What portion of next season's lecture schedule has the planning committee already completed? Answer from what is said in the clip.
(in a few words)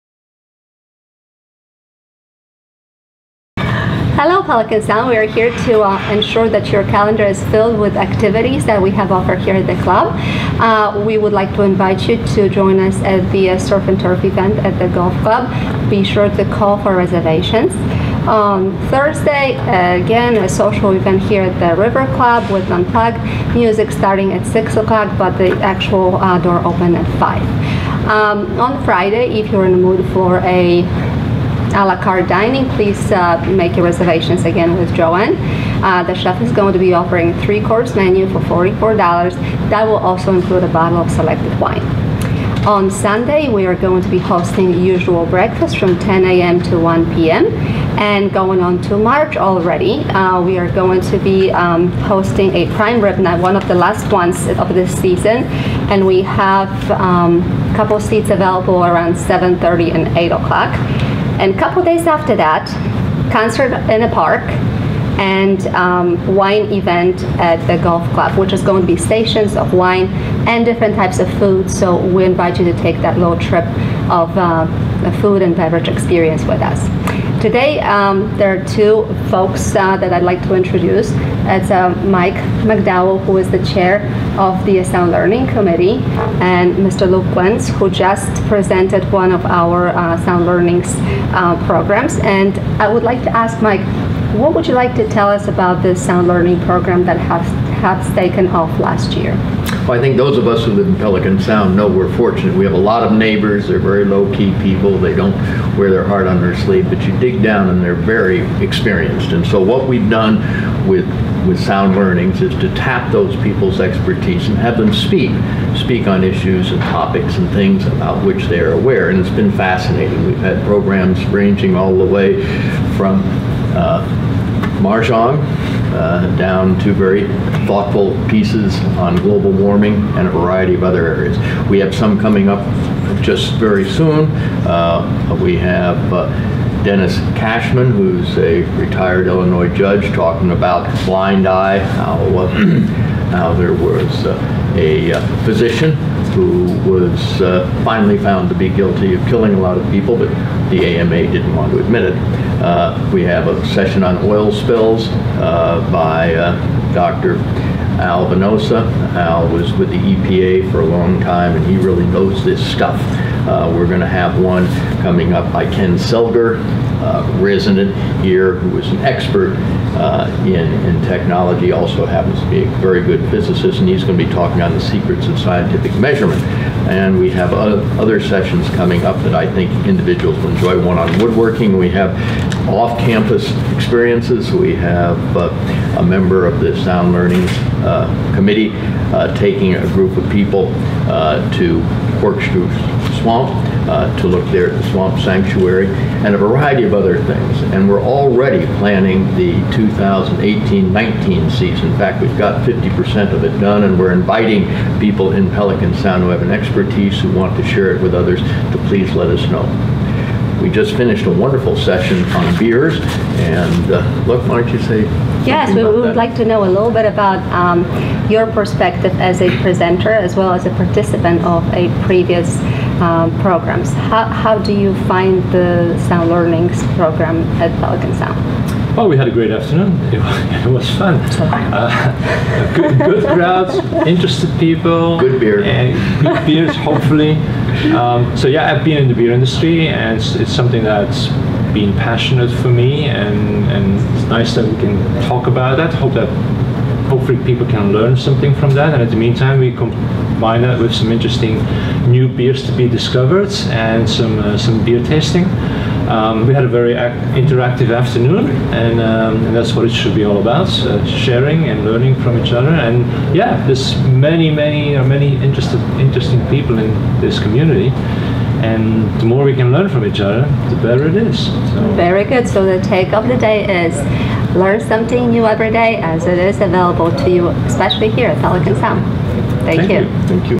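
50%.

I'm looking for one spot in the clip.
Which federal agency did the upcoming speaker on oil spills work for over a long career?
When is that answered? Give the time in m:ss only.
2:39.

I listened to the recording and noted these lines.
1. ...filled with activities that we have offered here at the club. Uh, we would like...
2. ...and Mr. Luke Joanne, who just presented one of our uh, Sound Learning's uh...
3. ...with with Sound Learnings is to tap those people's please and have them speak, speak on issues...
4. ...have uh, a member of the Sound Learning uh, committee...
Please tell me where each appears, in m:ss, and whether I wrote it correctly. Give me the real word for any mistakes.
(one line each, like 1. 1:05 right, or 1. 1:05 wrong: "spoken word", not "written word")
1. 0:07 right
2. 1:26 wrong: "Wentz", not "Joanne"
3. 1:50 wrong: "expertise", not "please"
4. 3:04 right.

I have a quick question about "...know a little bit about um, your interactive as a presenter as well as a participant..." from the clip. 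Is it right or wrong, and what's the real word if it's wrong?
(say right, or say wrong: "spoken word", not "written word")
wrong: "perspective", not "interactive".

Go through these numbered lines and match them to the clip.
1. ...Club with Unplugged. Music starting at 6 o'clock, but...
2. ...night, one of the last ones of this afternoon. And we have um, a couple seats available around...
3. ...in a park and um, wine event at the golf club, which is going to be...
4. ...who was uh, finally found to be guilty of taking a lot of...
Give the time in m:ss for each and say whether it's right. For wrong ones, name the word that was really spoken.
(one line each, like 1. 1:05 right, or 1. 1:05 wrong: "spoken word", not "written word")
1. 0:22 right
2. 0:53 wrong: "season", not "afternoon"
3. 1:03 right
4. 2:26 wrong: "killing", not "taking".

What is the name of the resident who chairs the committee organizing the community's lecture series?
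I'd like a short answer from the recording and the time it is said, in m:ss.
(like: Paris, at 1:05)
Mike McDowell, at 1:22.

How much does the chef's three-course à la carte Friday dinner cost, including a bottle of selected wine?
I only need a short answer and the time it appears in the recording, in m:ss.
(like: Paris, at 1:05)
$44, at 0:38.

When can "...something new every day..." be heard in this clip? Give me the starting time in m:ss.
4:34.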